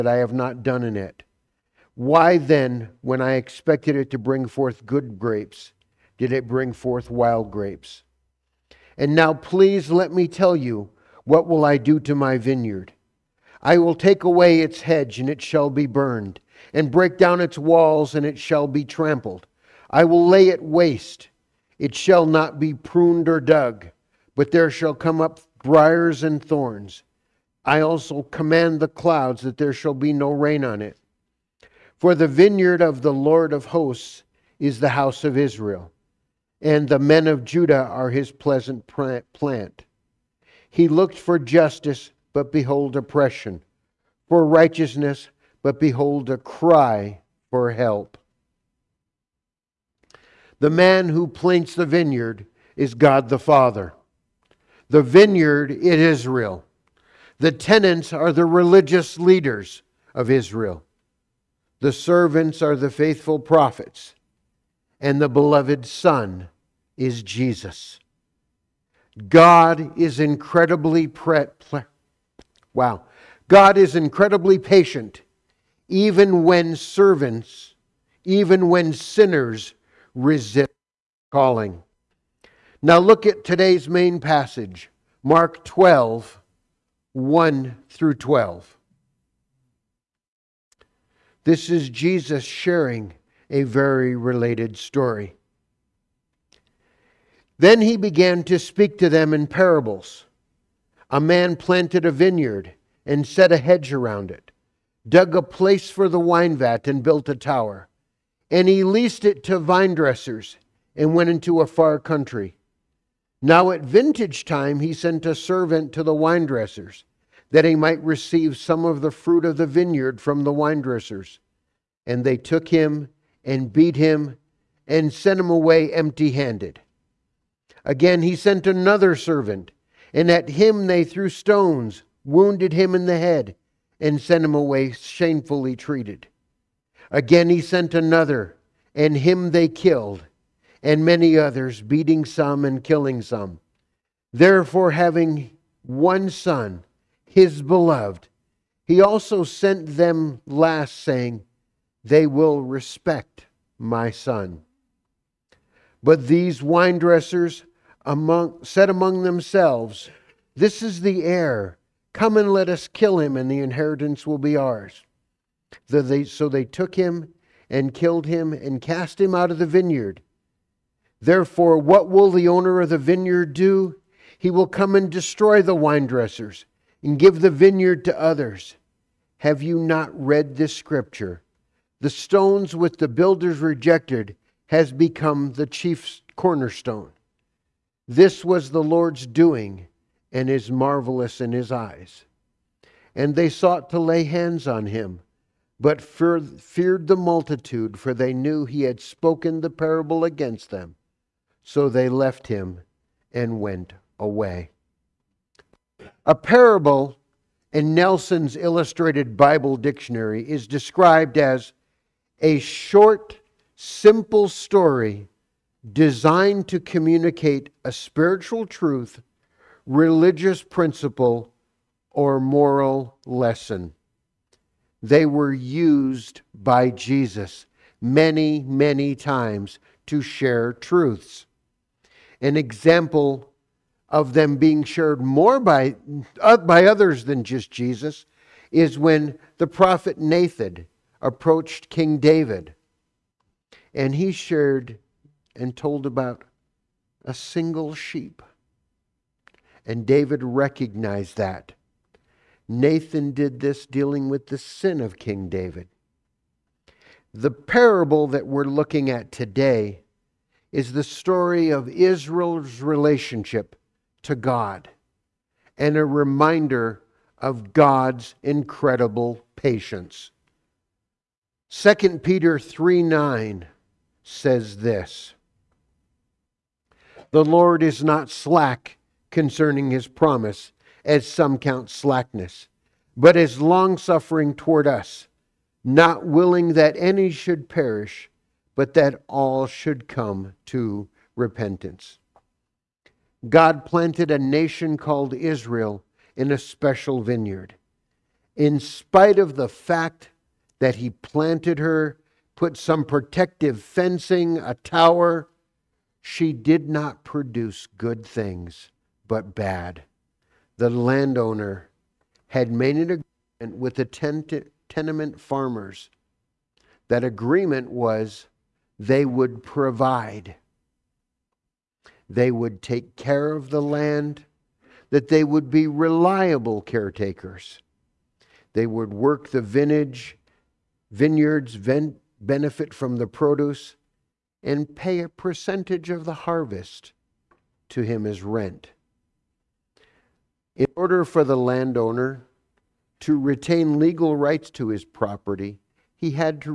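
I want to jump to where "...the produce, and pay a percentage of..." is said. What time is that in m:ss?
5:33.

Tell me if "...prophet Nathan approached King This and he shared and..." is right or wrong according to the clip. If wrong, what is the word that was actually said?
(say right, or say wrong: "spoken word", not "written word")
wrong: "David", not "This".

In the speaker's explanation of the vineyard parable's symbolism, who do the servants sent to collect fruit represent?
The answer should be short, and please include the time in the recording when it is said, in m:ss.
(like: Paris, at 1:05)
The faithful prophets, at 1:02.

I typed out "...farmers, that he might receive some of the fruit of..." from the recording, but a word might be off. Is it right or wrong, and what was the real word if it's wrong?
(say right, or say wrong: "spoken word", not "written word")
wrong: "dressers", not "farmers".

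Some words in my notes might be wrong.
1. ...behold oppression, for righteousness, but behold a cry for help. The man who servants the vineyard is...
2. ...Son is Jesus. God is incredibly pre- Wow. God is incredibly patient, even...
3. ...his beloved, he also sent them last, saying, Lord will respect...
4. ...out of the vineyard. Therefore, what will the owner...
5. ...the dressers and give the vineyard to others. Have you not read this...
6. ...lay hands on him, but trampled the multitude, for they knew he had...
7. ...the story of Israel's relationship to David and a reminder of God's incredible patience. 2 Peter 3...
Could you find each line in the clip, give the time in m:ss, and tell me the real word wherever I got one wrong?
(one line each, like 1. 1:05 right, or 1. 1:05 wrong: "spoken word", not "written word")
1. 0:42 wrong: "plants", not "servants"
2. 1:05 right
3. 2:27 wrong: "They", not "Lord"
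4. 2:49 right
5. 2:55 right
6. 3:13 wrong: "feared", not "trampled"
7. 4:20 wrong: "God", not "David".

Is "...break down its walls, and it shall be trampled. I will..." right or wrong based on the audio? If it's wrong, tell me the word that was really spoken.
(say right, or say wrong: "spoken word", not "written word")
right.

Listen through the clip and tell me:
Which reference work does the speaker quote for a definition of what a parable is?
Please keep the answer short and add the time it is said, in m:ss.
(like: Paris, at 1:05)
Nelson's Illustrated Bible Dictionary, at 3:27.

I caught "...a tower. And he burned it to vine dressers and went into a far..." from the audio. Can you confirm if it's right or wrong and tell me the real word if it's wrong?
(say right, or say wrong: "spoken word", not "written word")
wrong: "leased", not "burned".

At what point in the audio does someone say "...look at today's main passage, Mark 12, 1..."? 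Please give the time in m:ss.
1:22.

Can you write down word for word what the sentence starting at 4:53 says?
God planted a nation called Israel in a special vineyard.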